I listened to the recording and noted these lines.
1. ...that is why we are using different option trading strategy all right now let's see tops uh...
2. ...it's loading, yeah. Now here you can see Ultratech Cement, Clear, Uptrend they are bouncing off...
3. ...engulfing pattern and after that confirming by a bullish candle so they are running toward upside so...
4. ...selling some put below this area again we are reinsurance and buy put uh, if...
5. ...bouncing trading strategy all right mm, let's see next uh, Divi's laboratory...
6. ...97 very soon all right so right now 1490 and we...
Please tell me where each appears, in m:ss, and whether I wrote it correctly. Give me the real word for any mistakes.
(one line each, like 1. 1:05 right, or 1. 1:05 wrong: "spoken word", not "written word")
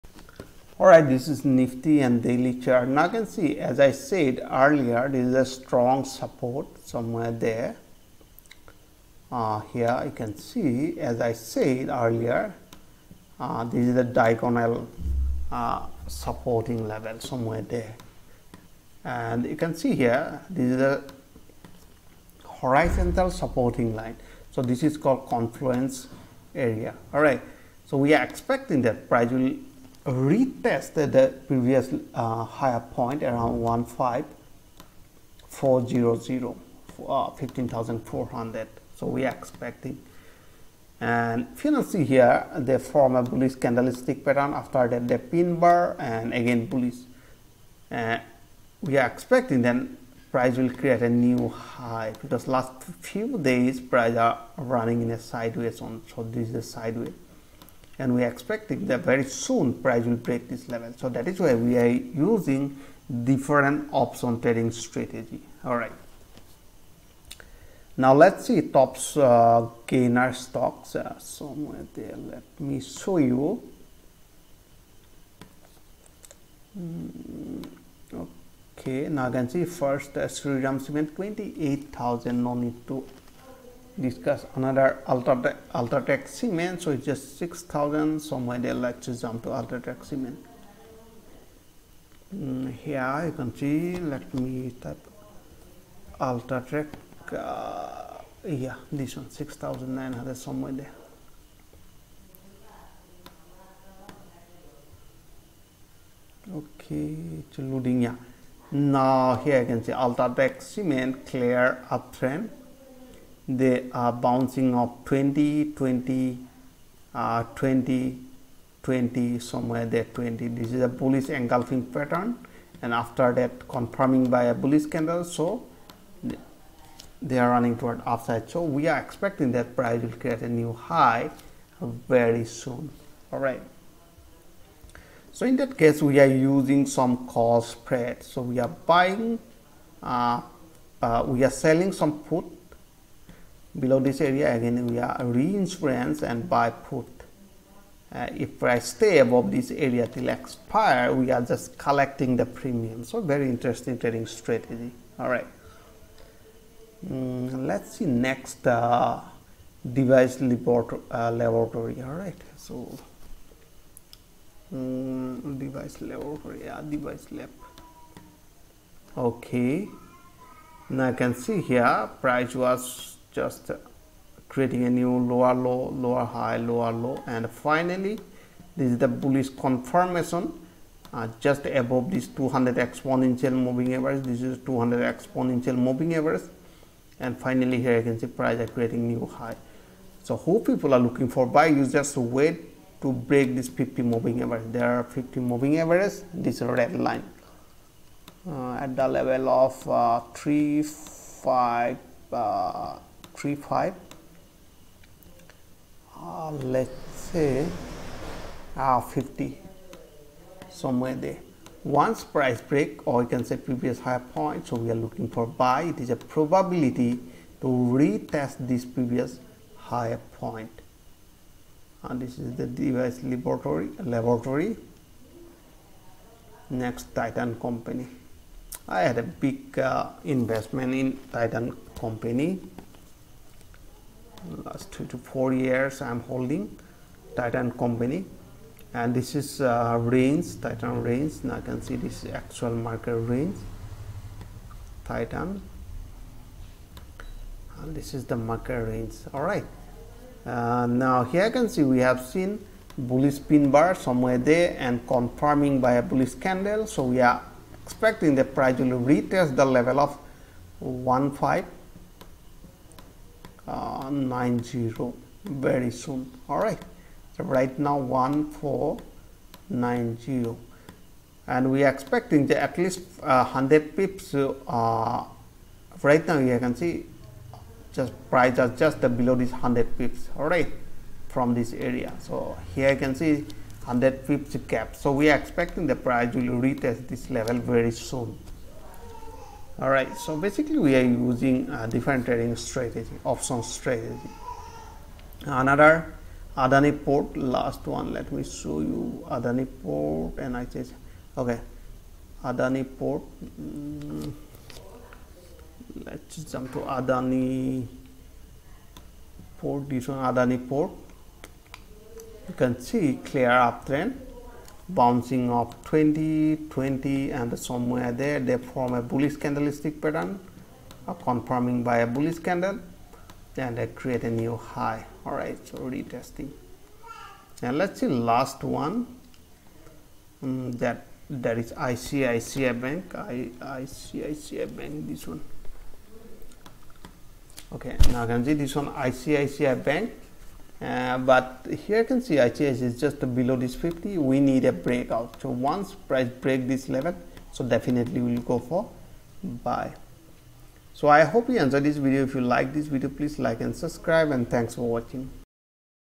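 1. 1:01 right
2. 1:47 right
3. 2:01 right
4. 2:21 right
5. 2:33 wrong: "interesting", not "bouncing"
6. 4:24 wrong: "90", not "97".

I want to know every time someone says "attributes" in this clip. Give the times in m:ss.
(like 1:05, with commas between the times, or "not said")
not said.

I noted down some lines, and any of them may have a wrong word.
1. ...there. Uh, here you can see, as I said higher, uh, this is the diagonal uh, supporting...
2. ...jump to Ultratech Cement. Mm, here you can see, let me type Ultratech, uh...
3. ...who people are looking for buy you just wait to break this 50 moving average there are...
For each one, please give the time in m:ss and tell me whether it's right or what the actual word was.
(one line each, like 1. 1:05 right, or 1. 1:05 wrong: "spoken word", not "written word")
1. 0:07 wrong: "earlier", not "higher"
2. 1:29 right
3. 3:10 right.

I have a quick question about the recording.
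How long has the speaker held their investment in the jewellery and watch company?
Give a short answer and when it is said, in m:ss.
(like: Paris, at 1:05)
two to four years, at 3:54.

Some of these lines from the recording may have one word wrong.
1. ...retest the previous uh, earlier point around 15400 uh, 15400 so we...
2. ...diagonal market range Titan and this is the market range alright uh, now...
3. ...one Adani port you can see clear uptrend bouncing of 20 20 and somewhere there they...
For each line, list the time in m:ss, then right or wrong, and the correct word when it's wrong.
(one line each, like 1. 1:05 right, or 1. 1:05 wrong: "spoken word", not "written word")
1. 0:30 wrong: "higher", not "earlier"
2. 4:02 wrong: "actual", not "diagonal"
3. 5:10 right.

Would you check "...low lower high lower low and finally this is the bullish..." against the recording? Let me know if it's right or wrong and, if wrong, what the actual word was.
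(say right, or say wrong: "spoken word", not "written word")
right.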